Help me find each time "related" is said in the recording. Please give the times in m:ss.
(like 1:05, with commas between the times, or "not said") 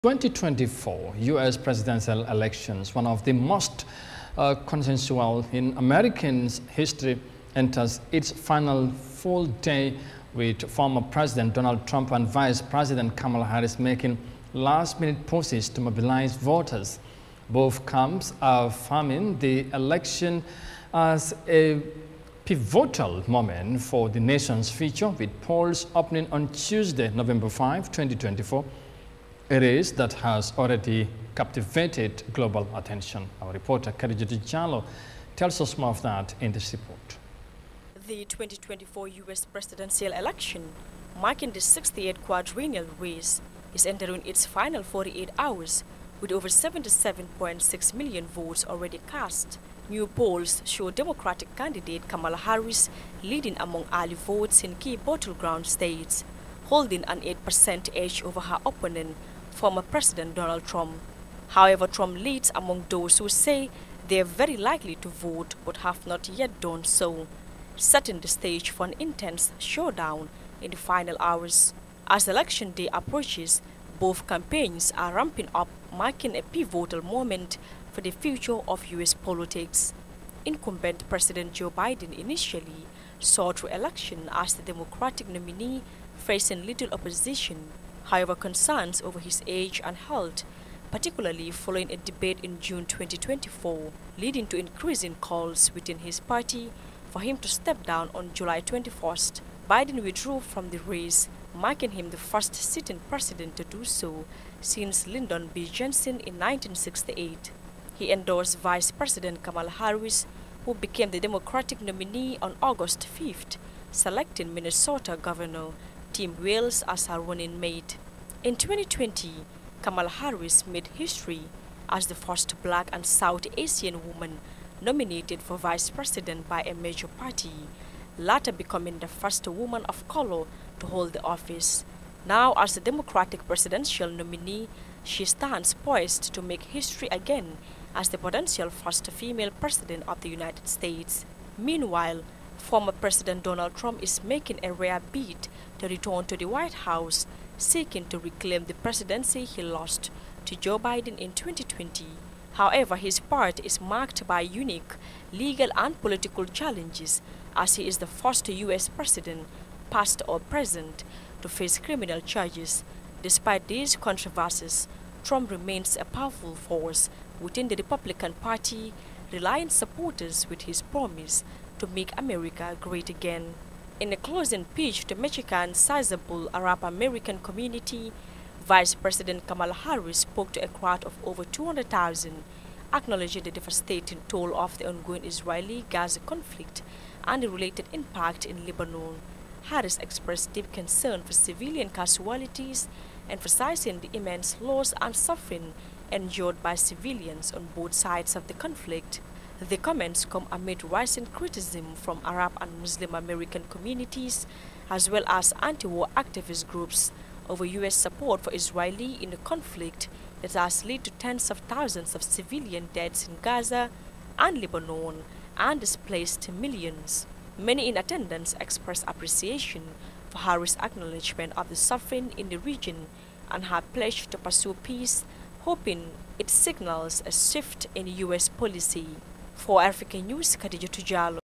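3:07.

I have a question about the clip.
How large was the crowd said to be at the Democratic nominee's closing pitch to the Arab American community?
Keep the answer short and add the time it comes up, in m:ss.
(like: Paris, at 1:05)
over 200,000, at 3:01.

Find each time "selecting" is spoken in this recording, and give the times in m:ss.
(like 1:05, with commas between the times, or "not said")
1:53.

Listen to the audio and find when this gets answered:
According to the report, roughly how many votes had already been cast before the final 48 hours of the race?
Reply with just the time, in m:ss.
0:46.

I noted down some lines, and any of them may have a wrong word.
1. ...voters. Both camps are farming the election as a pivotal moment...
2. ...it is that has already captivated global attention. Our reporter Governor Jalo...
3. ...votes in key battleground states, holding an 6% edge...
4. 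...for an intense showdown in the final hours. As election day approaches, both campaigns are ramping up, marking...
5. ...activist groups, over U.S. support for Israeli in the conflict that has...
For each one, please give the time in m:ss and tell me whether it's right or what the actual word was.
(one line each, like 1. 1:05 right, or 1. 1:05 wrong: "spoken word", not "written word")
1. 0:16 right
2. 0:29 wrong: "Karijit", not "Governor"
3. 0:54 wrong: "8", not "6"
4. 1:08 right
5. 3:26 right.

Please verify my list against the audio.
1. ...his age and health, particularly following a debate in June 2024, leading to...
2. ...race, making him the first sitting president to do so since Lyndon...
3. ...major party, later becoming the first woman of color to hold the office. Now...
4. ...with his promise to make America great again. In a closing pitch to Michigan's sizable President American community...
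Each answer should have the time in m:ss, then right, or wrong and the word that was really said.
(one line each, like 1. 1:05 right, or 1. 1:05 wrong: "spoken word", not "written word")
1. 1:29 right
2. 1:40 right
3. 2:06 right
4. 2:50 wrong: "Arab", not "President".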